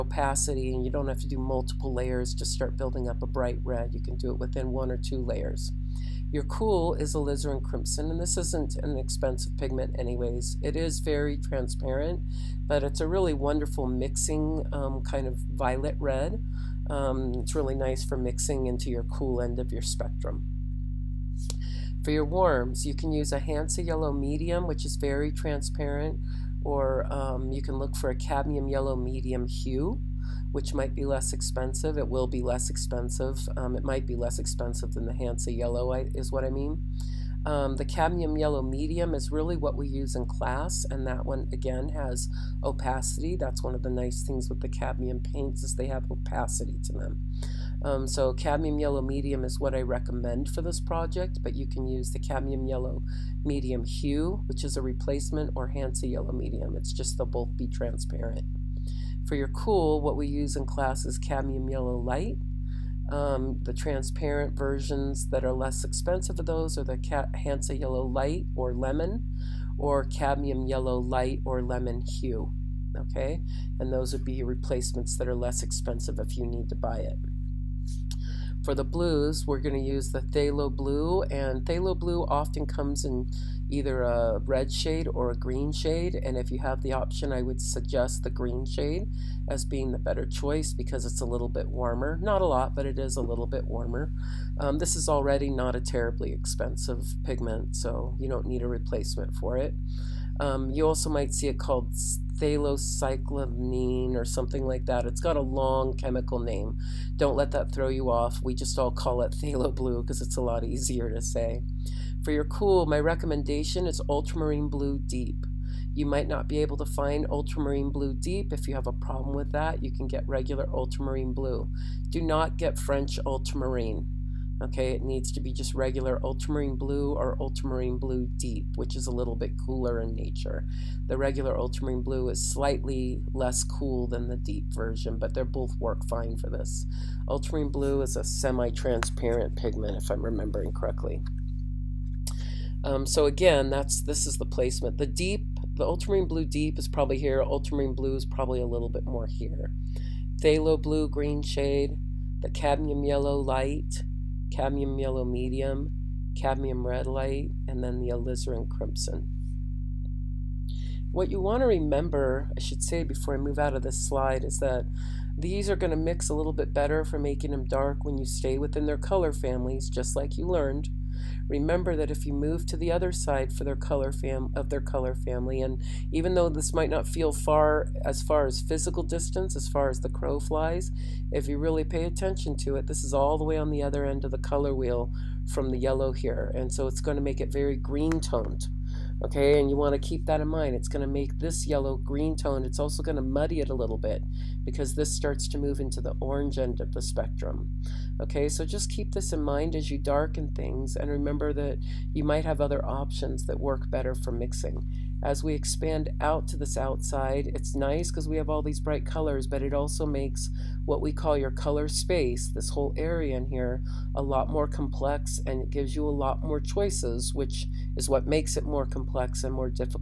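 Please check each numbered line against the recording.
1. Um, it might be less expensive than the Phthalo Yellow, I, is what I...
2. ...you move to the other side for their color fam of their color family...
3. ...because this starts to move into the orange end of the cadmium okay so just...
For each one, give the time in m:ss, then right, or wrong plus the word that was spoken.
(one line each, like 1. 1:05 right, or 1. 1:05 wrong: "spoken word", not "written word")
1. 0:33 wrong: "Hansa", not "Phthalo"
2. 2:52 right
3. 3:14 wrong: "spectrum", not "cadmium".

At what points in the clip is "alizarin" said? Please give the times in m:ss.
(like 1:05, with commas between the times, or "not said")
0:07, 2:38.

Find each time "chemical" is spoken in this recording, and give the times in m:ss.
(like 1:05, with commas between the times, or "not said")
1:45.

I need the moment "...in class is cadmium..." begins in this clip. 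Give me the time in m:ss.
1:00.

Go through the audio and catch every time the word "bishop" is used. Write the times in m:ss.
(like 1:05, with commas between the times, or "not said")
not said.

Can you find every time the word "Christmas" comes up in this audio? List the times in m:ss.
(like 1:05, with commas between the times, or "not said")
not said.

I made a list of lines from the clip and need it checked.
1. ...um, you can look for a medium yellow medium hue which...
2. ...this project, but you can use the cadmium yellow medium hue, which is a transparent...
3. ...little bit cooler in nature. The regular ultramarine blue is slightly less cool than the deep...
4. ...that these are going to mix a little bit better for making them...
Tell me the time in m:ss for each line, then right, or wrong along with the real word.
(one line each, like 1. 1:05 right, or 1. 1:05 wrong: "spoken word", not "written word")
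1. 0:27 wrong: "cadmium", not "medium"
2. 0:50 wrong: "replacement", not "transparent"
3. 2:09 right
4. 2:44 right.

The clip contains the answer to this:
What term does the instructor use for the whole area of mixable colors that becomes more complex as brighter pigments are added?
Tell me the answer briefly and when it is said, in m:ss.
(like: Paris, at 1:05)
color space, at 3:31.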